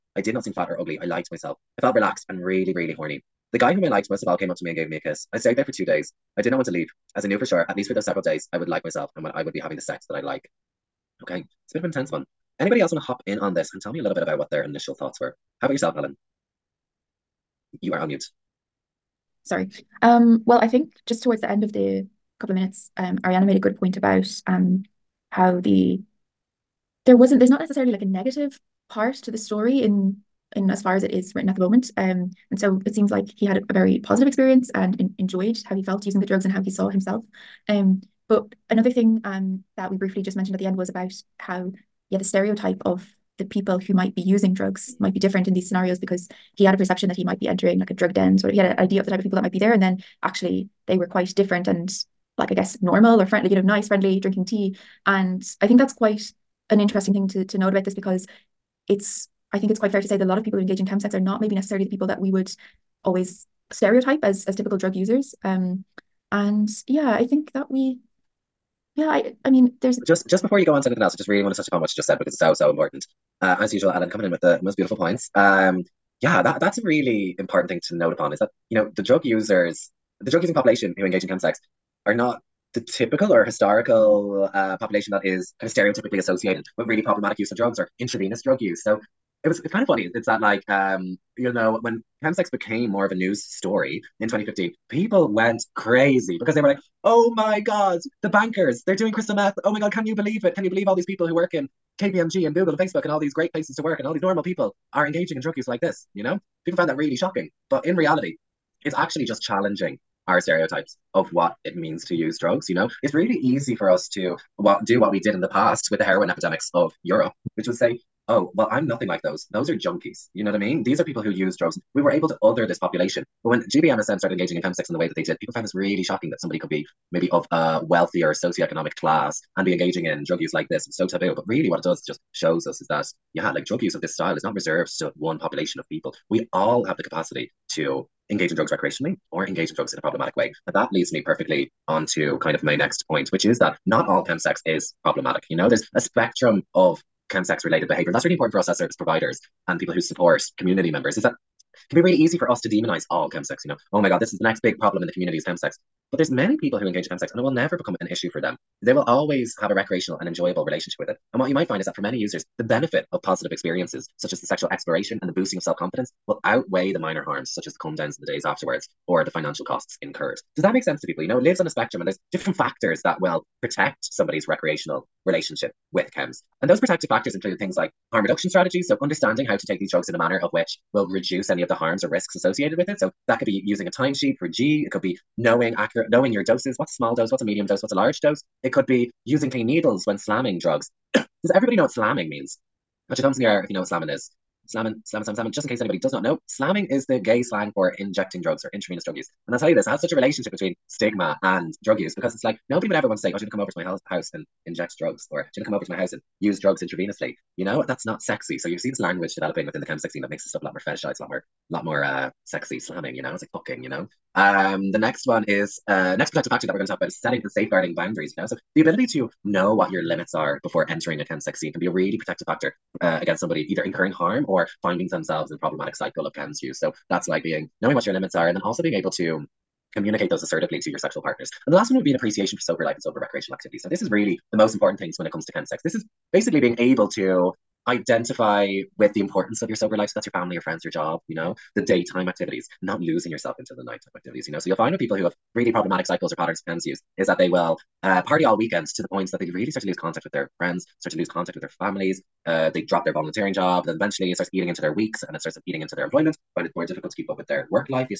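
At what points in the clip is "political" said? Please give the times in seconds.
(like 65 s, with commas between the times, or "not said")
not said.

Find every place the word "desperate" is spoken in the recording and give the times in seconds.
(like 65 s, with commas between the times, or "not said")
not said.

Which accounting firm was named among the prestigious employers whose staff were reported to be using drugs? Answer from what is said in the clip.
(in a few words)
KPMG.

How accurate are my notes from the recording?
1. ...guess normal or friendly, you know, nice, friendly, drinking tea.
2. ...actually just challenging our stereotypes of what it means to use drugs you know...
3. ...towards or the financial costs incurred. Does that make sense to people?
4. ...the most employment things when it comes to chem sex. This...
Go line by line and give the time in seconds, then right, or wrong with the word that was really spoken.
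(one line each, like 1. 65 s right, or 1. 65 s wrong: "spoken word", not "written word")
1. 52 s right
2. 108 s right
3. 168 s wrong: "afterwards", not "towards"
4. 234 s wrong: "important", not "employment".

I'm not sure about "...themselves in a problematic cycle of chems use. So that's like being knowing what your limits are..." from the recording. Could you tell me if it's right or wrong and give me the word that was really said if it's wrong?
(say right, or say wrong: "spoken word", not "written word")
right.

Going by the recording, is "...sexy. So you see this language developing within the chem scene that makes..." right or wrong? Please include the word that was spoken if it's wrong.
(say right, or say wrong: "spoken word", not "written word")
right.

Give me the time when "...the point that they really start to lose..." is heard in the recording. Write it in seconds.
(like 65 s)
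249 s.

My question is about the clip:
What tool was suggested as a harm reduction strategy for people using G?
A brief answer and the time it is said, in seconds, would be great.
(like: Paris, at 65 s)
A timesheet, at 183 s.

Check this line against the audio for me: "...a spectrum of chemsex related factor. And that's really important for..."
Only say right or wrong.
wrong.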